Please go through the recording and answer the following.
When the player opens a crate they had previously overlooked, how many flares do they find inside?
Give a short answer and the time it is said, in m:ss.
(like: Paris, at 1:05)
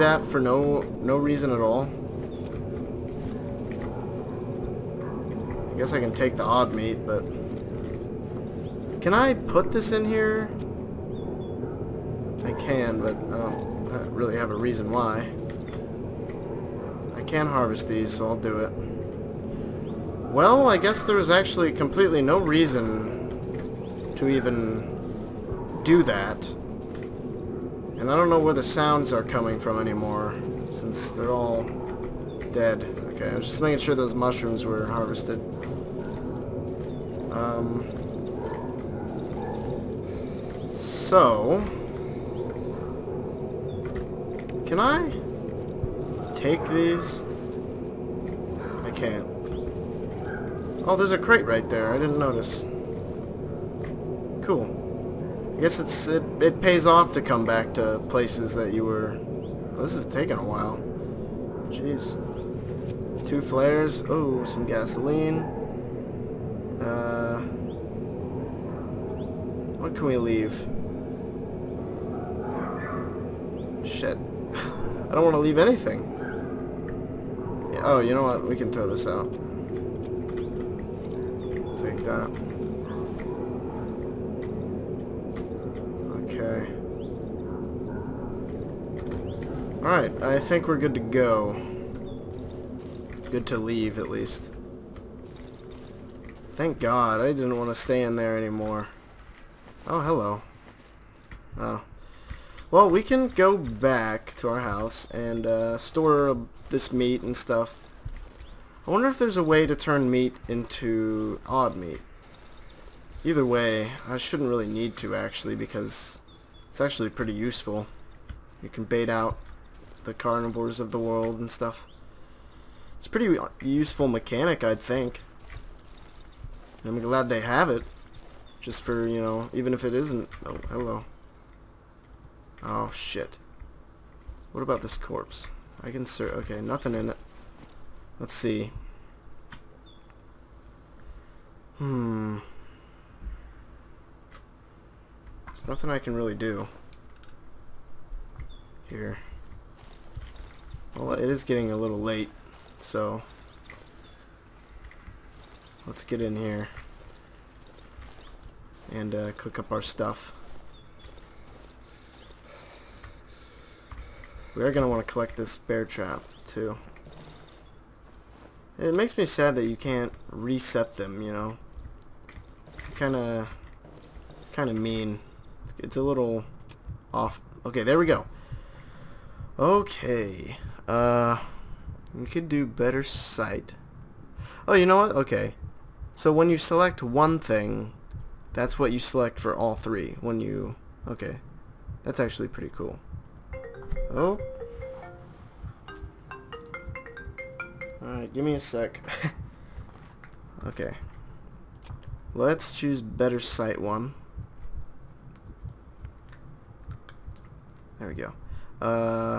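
2, at 1:03.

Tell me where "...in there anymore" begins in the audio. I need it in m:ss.
1:38.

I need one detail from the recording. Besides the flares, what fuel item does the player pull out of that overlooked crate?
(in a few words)
Gasoline.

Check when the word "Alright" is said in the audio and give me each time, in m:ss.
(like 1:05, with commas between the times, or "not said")
1:29, 3:18.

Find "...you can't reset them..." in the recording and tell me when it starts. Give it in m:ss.
2:49.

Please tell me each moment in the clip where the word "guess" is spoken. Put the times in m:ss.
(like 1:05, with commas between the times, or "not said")
0:05, 0:20, 0:55.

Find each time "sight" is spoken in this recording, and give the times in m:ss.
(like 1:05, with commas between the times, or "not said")
3:03, 3:23.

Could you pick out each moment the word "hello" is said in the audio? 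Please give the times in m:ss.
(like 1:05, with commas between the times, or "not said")
1:40, 2:10.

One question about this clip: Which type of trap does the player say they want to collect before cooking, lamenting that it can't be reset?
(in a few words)
Bear trap.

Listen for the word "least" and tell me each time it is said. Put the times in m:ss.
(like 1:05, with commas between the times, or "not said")
1:34.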